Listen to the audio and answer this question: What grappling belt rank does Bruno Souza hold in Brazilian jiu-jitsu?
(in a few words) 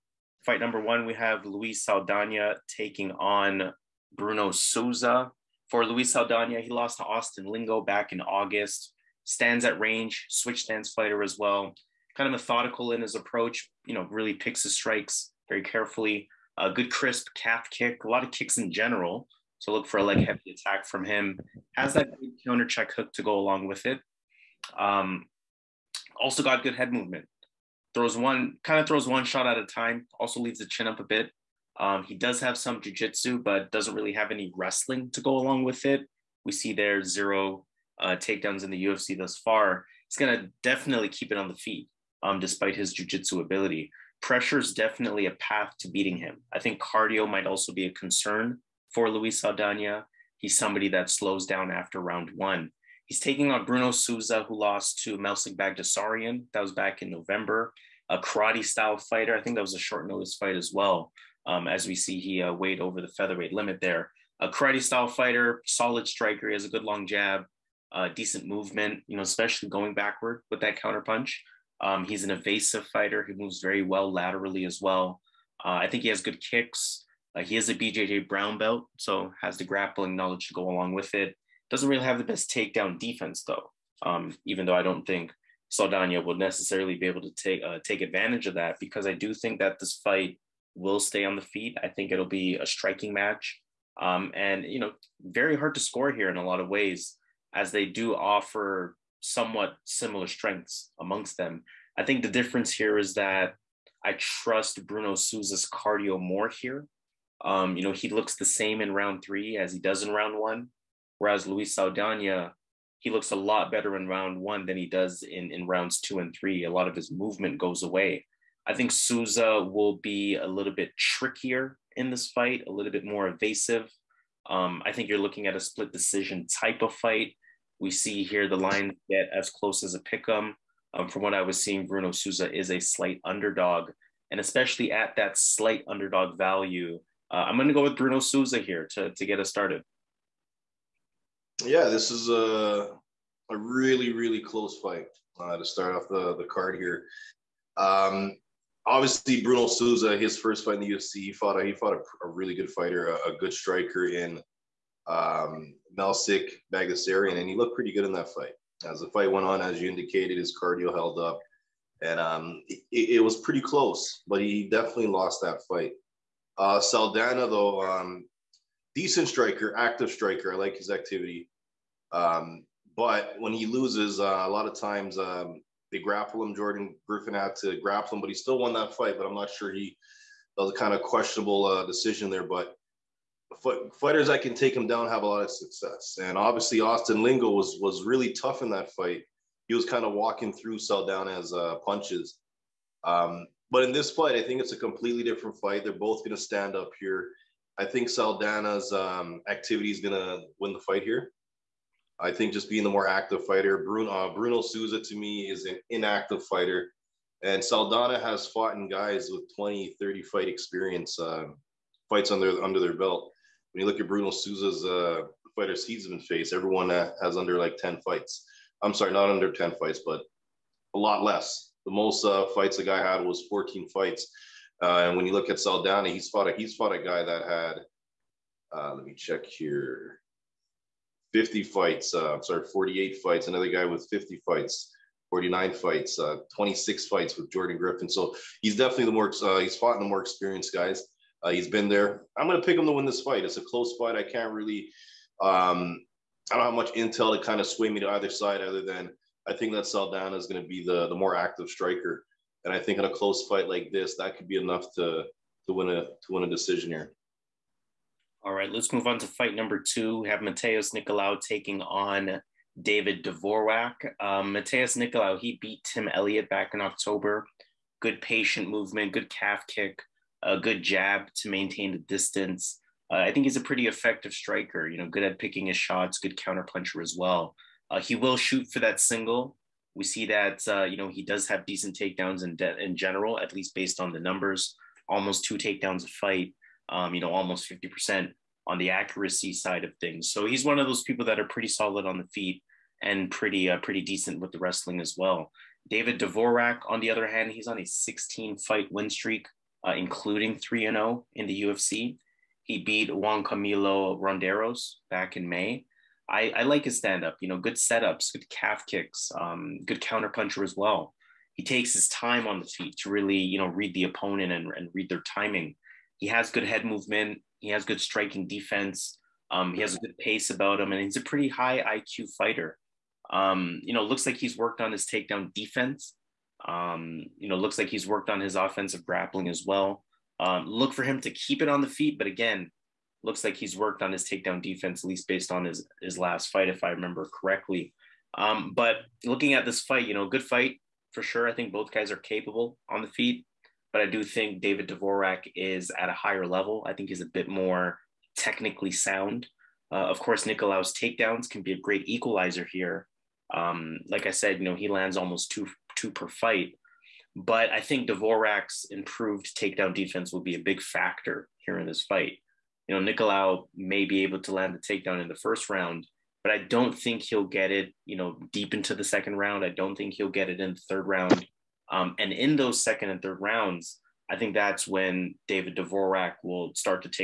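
brown belt.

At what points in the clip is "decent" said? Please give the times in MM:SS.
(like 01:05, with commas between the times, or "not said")
01:08, 02:48, 04:41, 04:54.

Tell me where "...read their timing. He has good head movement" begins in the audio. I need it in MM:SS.
05:14.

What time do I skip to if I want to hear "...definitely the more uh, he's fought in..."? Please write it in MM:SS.
03:58.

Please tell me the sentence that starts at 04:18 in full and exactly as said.
All right, let's move on to fight number two.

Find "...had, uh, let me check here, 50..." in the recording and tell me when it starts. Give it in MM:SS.
03:47.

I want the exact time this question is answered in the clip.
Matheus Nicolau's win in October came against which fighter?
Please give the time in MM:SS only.
04:25.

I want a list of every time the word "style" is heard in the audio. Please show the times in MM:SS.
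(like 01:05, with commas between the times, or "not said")
00:58, 01:04.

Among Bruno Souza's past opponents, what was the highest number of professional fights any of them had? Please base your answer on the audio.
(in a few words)
14.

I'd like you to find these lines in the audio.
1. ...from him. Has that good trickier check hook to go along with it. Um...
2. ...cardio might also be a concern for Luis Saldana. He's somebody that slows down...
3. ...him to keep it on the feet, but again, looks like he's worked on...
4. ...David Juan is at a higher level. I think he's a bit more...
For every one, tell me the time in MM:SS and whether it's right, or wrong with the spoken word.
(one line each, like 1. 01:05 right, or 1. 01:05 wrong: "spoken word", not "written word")
1. 00:20 wrong: "counter", not "trickier"
2. 00:46 right
3. 05:31 right
4. 05:44 wrong: "Dvorak", not "Juan".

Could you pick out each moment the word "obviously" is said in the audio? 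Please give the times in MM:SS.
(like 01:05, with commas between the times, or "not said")
02:28, 03:06.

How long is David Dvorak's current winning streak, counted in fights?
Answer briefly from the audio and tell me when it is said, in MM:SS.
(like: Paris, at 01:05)
16, at 04:57.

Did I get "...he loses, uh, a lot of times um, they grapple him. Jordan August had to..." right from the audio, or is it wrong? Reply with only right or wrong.
wrong.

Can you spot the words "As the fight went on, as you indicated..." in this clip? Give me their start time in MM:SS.
02:38.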